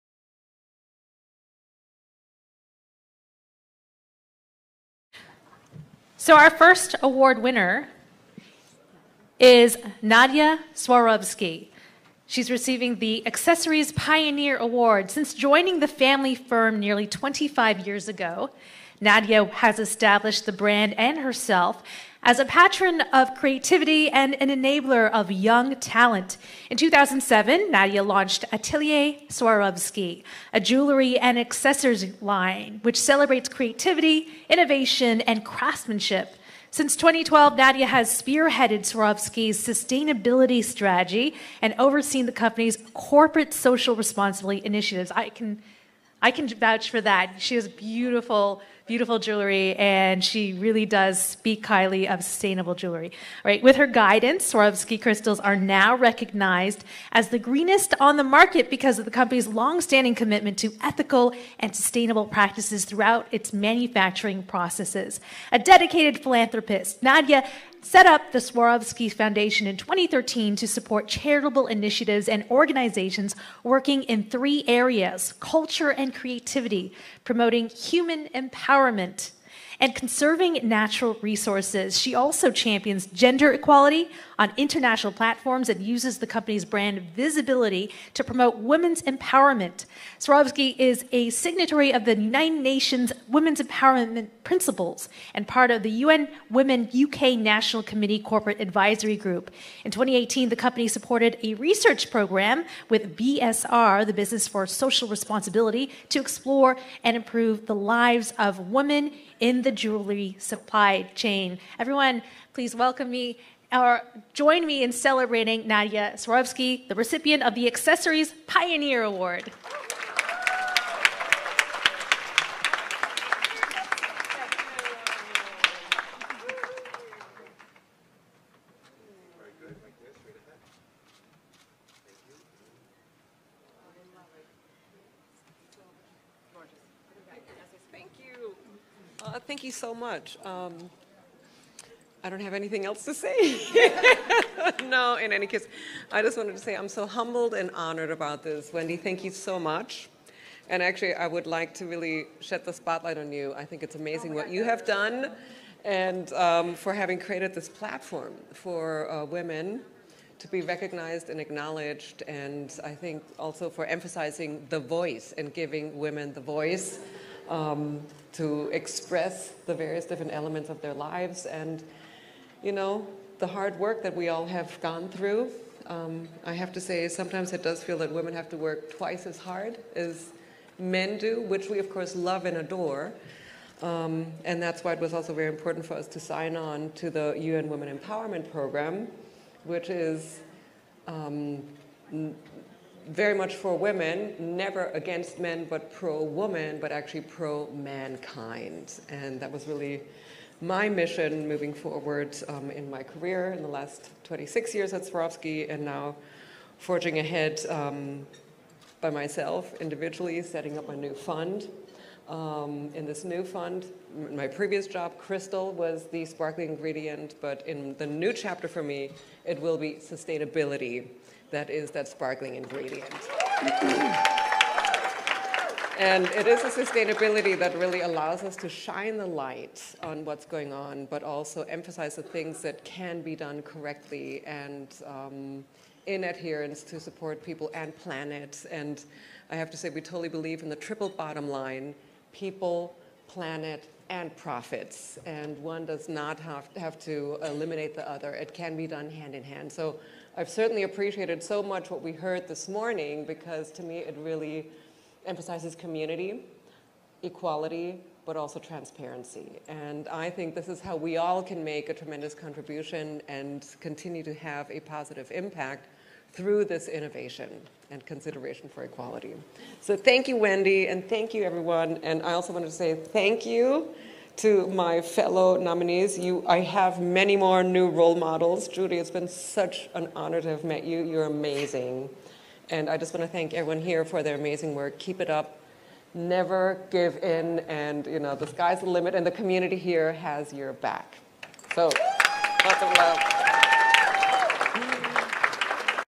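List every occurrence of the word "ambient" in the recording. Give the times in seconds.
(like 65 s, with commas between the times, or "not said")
not said.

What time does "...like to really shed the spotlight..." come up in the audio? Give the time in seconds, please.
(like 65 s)
151 s.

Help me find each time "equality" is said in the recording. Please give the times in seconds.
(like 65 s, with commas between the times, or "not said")
83 s, 257 s, 268 s.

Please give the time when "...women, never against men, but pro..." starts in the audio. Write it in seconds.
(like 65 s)
193 s.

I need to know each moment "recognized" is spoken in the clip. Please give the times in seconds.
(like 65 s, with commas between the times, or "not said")
55 s, 160 s.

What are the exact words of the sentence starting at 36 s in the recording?
Since 2012, Nadja has spearheaded Swarovski's sustainability strategy and overseen the company's corporate social responsibility initiatives.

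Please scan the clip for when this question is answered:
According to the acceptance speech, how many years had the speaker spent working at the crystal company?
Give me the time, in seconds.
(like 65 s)
204 s.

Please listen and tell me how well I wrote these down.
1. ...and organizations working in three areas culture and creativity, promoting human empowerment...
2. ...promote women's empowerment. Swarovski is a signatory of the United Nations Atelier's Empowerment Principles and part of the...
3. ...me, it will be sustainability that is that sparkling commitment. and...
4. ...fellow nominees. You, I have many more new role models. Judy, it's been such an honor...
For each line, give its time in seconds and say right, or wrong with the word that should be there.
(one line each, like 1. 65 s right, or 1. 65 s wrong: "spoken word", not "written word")
1. 72 s right
2. 88 s wrong: "Women", not "Atelier"
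3. 218 s wrong: "ingredient", not "commitment"
4. 275 s right.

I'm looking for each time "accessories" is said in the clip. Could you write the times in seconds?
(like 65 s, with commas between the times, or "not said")
13 s, 31 s, 117 s.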